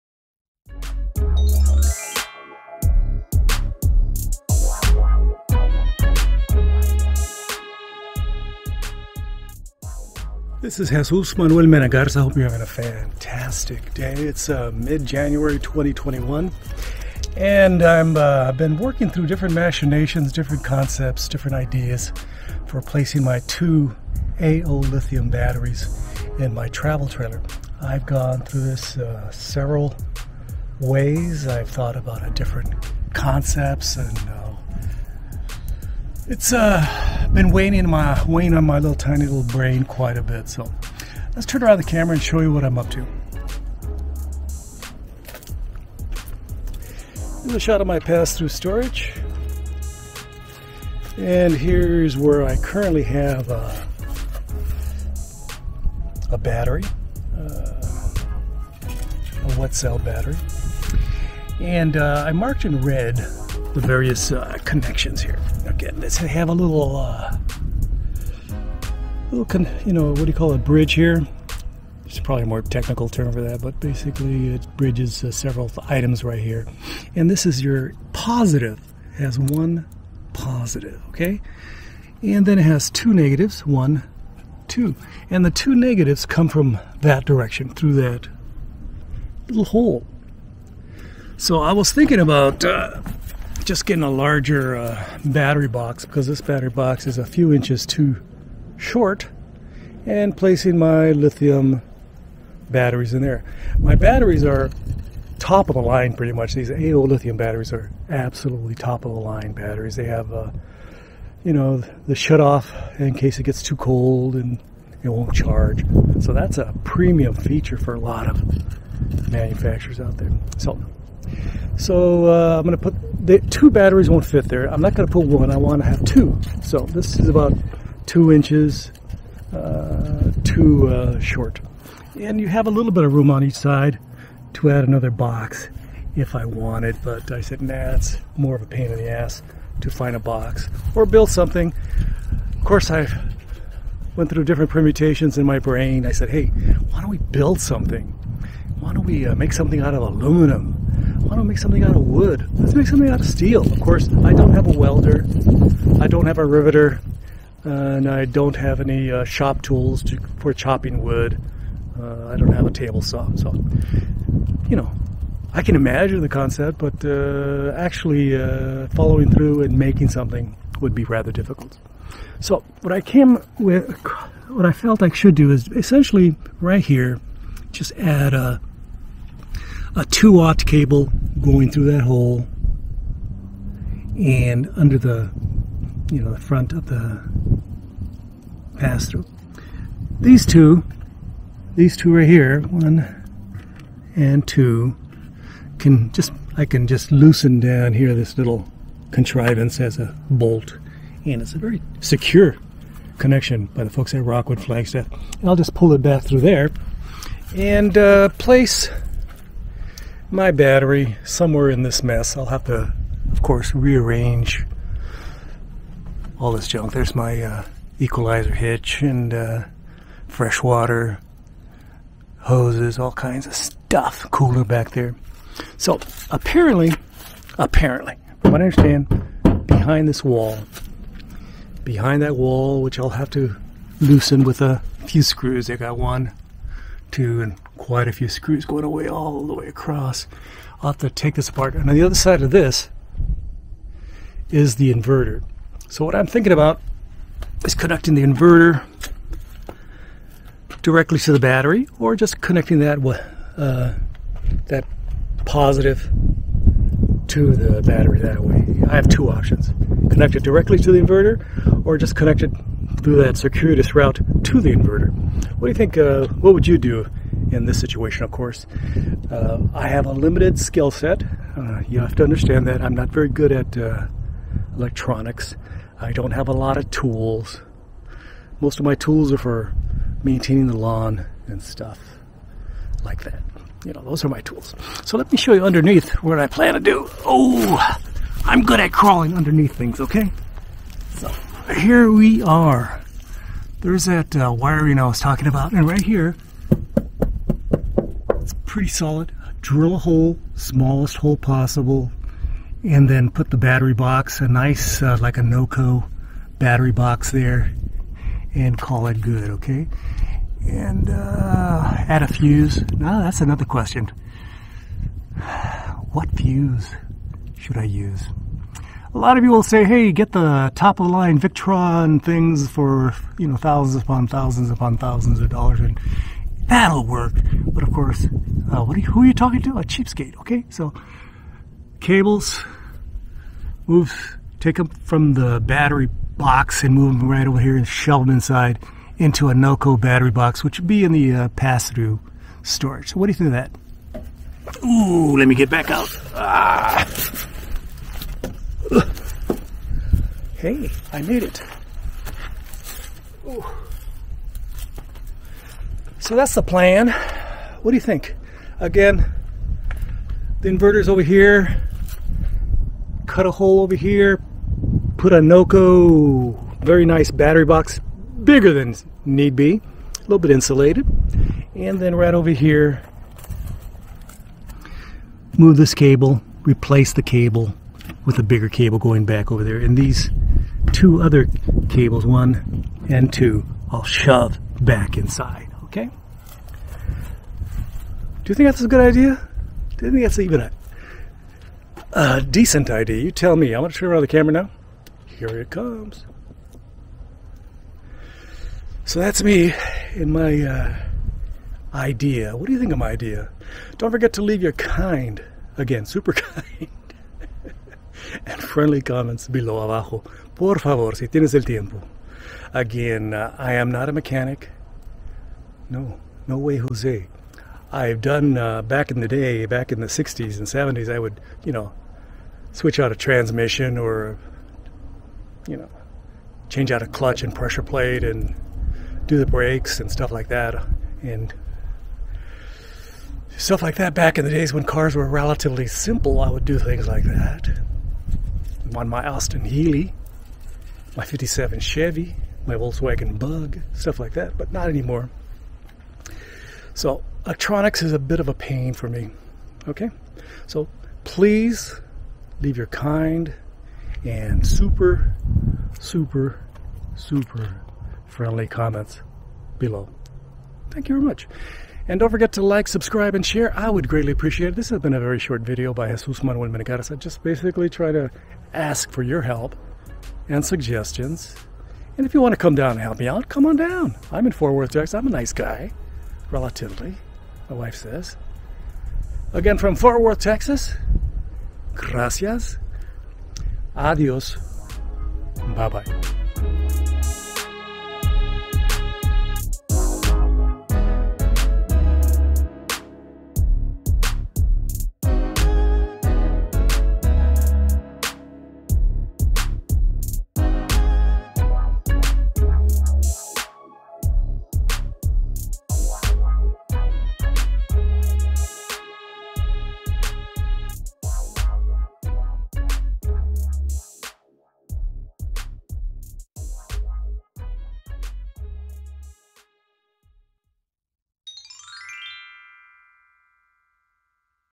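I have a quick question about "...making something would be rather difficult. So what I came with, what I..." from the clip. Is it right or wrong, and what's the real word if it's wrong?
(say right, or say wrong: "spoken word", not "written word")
right.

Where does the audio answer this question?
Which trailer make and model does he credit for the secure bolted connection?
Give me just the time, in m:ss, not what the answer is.
3:24.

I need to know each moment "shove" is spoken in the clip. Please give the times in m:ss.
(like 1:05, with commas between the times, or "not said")
5:37, 6:24.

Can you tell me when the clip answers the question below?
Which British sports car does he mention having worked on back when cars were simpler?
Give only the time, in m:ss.
7:19.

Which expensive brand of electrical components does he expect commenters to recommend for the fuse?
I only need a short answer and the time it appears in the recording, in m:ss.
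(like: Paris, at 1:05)
Victron, at 5:21.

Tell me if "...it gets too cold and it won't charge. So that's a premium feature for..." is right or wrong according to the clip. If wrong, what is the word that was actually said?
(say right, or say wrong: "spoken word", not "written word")
right.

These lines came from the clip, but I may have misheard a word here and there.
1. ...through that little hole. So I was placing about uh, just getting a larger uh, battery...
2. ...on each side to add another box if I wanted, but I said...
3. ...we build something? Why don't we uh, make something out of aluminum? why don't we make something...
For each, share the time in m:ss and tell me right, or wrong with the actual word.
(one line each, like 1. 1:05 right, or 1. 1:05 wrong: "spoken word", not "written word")
1. 1:27 wrong: "thinking", not "placing"
2. 2:13 right
3. 2:27 right.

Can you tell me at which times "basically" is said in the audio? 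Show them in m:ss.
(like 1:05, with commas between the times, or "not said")
1:13, 7:47.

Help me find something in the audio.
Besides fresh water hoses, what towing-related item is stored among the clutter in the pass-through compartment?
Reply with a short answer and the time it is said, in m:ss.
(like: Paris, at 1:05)
equalizer hitch, at 3:37.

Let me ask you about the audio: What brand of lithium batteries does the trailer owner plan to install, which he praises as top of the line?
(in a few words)
AoLithium.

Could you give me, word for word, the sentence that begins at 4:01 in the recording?
And on the other side of this is the inverter.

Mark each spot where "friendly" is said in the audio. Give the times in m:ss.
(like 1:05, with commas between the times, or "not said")
6:48, 7:38.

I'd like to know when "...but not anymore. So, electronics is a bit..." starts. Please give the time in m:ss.
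7:24.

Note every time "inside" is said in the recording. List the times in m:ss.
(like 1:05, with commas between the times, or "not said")
5:38, 6:25.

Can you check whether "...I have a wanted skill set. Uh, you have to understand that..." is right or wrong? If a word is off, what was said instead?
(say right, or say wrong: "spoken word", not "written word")
wrong: "limited", not "wanted".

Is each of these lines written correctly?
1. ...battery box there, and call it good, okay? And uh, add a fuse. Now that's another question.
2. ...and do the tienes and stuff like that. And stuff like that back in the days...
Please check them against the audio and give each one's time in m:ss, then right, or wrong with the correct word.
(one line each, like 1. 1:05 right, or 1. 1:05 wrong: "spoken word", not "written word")
1. 5:06 right
2. 7:08 wrong: "brakes", not "tienes".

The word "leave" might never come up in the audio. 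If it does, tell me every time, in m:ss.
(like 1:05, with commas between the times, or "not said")
6:44, 7:32.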